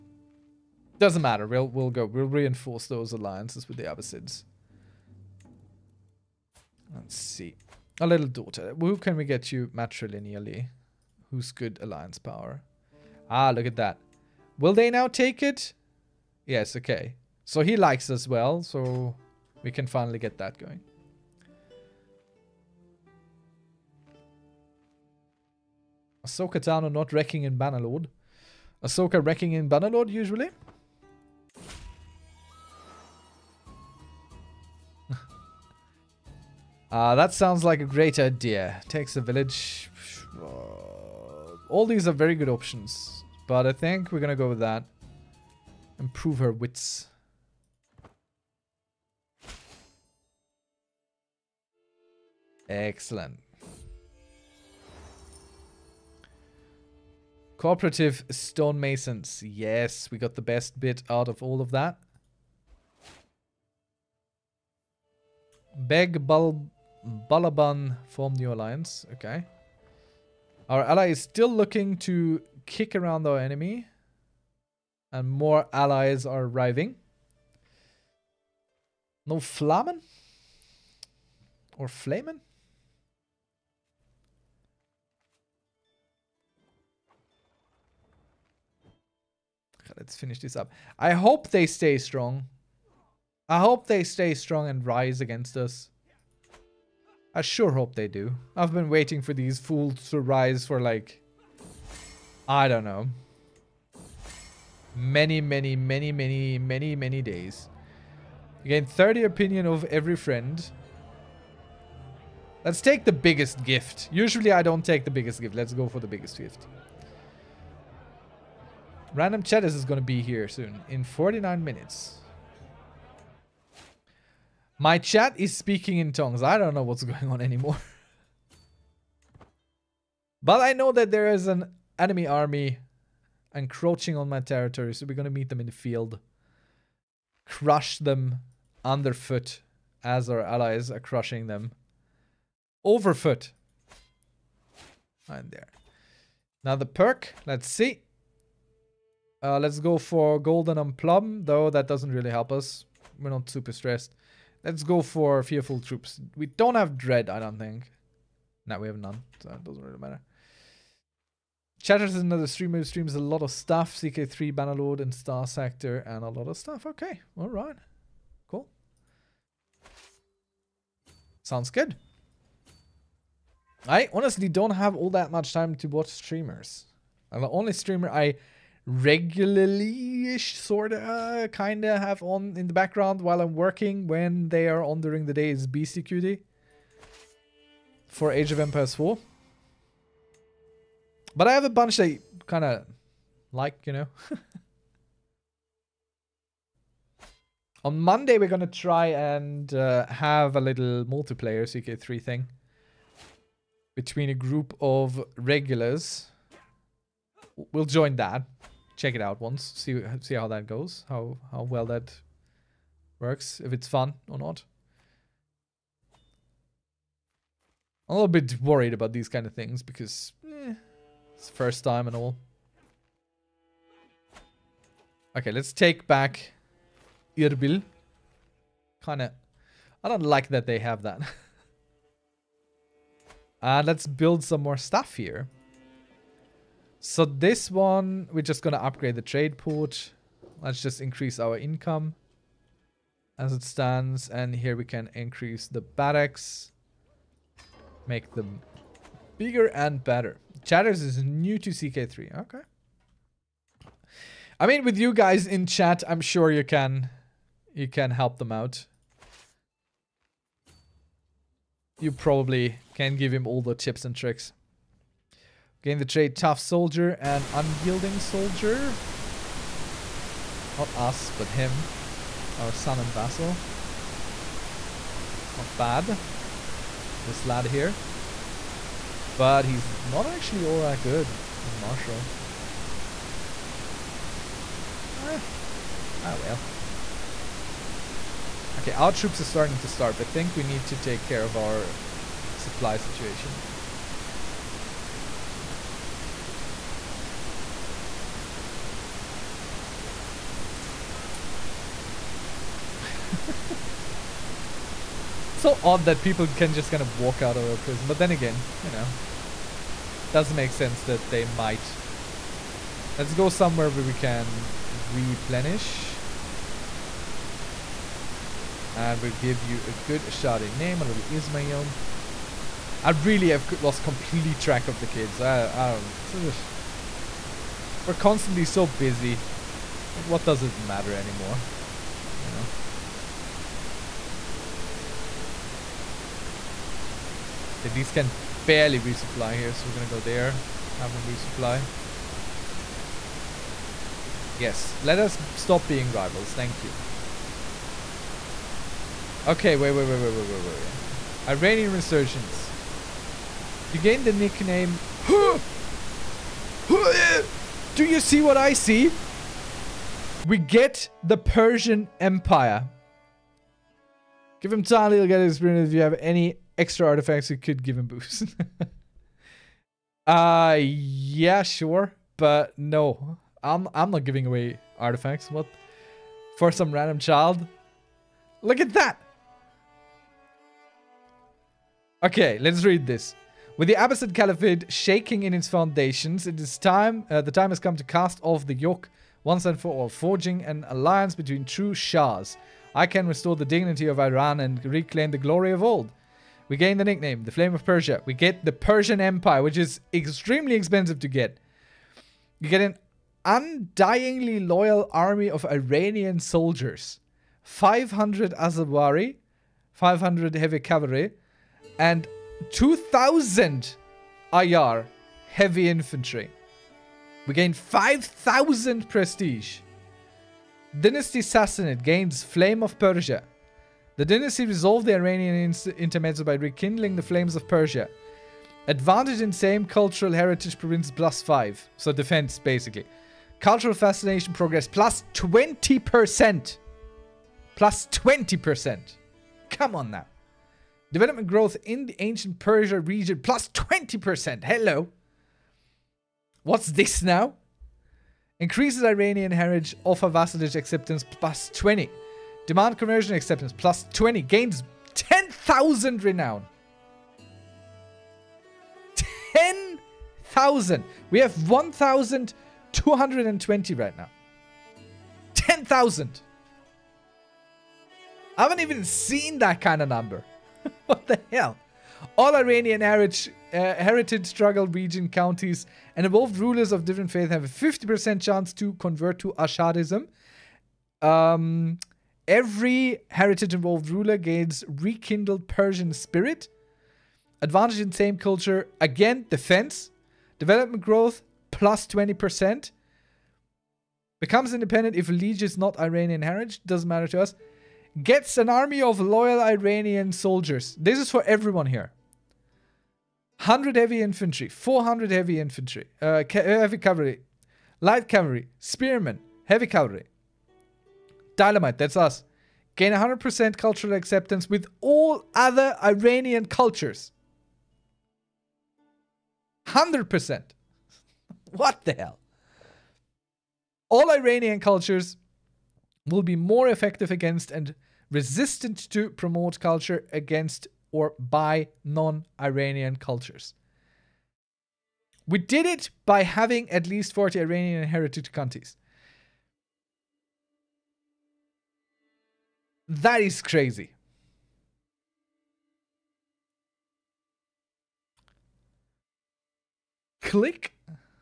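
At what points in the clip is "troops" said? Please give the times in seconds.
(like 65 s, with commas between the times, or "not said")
155 s, 289 s.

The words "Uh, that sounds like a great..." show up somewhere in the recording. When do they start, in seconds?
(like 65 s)
36 s.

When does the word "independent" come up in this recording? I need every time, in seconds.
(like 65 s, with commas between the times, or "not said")
494 s.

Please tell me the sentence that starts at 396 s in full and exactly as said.
We gain the nickname, the Flame of Persia.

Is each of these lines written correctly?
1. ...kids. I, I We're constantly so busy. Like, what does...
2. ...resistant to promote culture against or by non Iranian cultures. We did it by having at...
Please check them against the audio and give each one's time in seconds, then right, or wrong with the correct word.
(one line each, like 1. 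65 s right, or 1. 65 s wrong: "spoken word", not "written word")
1. 325 s right
2. 528 s right.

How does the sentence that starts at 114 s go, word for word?
Usually I don't take the biggest gift.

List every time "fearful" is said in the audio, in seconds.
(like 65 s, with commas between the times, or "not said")
155 s.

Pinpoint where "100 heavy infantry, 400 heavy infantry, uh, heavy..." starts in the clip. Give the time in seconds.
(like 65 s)
503 s.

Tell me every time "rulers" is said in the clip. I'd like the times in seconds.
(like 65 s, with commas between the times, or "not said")
476 s, 484 s.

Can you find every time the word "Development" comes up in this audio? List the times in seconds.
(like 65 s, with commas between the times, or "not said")
441 s, 490 s.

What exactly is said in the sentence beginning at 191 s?
But I have a bunch that kind of like, you know.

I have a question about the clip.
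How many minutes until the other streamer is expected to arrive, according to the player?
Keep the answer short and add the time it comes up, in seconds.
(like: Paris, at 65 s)
49, at 121 s.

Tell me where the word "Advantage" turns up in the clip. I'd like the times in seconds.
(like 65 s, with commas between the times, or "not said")
428 s, 487 s.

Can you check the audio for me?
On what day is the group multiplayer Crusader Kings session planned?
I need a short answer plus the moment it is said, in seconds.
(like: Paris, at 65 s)
Monday, at 197 s.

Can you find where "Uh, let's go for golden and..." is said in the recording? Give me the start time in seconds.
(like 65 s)
149 s.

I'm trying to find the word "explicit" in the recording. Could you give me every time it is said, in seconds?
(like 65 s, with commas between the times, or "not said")
not said.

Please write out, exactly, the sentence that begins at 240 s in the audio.
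Let's just increase our income as it stands.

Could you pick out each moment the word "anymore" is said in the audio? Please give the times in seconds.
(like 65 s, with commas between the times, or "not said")
127 s, 331 s.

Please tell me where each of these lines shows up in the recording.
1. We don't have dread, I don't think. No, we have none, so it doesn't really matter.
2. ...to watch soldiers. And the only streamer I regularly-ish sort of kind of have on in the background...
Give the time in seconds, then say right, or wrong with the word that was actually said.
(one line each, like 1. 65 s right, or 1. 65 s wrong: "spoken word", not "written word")
1. 156 s right
2. 175 s wrong: "streamers", not "soldiers".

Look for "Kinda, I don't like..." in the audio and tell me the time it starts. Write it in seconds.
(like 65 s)
229 s.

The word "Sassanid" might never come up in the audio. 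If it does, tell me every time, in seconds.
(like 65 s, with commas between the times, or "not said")
421 s.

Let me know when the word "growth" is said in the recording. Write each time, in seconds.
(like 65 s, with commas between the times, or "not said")
441 s, 491 s.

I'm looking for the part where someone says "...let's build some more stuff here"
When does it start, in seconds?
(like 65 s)
233 s.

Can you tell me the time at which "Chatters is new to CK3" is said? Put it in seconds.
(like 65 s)
250 s.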